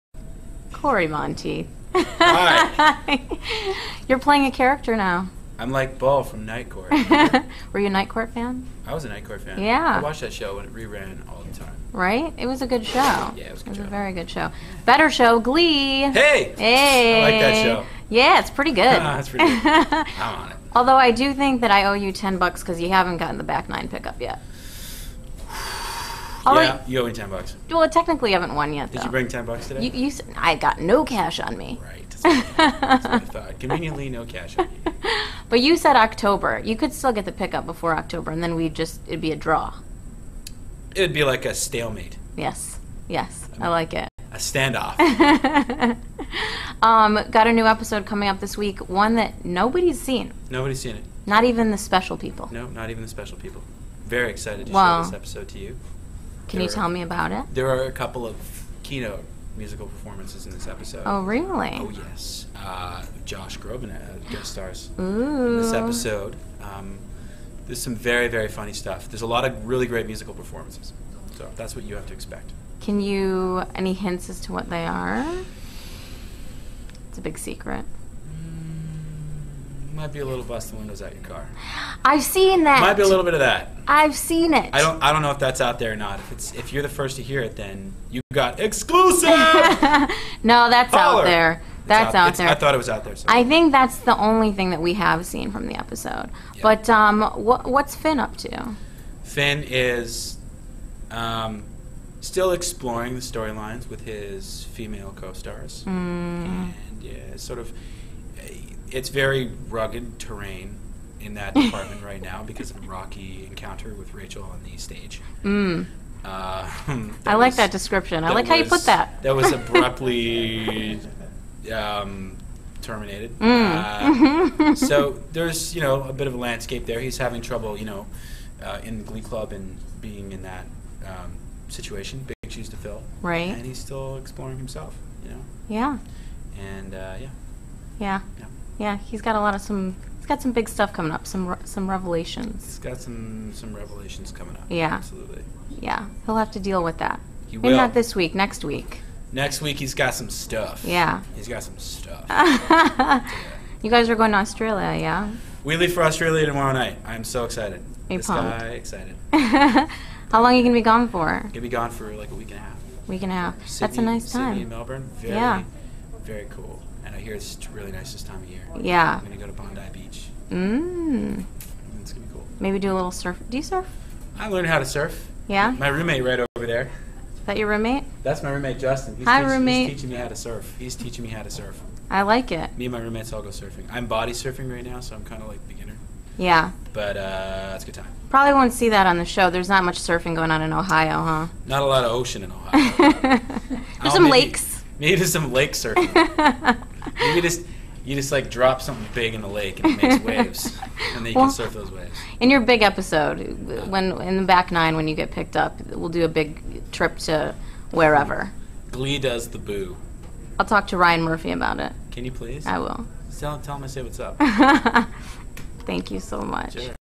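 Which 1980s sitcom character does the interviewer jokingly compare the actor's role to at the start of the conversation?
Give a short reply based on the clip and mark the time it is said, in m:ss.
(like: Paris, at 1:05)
Bull from Night Court, at 0:05.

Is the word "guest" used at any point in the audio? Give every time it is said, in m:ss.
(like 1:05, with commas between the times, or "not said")
1:04.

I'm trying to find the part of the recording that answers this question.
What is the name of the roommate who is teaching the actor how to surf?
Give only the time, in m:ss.
2:58.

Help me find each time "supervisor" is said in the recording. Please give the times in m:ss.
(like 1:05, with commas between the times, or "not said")
not said.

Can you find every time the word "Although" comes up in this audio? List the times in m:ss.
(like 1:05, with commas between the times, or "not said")
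0:20, 0:26.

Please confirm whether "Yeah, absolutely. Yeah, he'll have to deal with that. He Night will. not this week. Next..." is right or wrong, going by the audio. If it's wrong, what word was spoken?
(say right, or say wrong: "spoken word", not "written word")
wrong: "Maybe", not "Night".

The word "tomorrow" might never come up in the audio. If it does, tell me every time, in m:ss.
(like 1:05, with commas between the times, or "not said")
2:36.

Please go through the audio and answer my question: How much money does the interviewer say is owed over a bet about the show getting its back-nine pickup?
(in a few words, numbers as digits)
$10.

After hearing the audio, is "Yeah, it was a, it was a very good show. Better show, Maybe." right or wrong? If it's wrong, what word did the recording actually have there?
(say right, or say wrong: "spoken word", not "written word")
wrong: "Glee", not "Maybe".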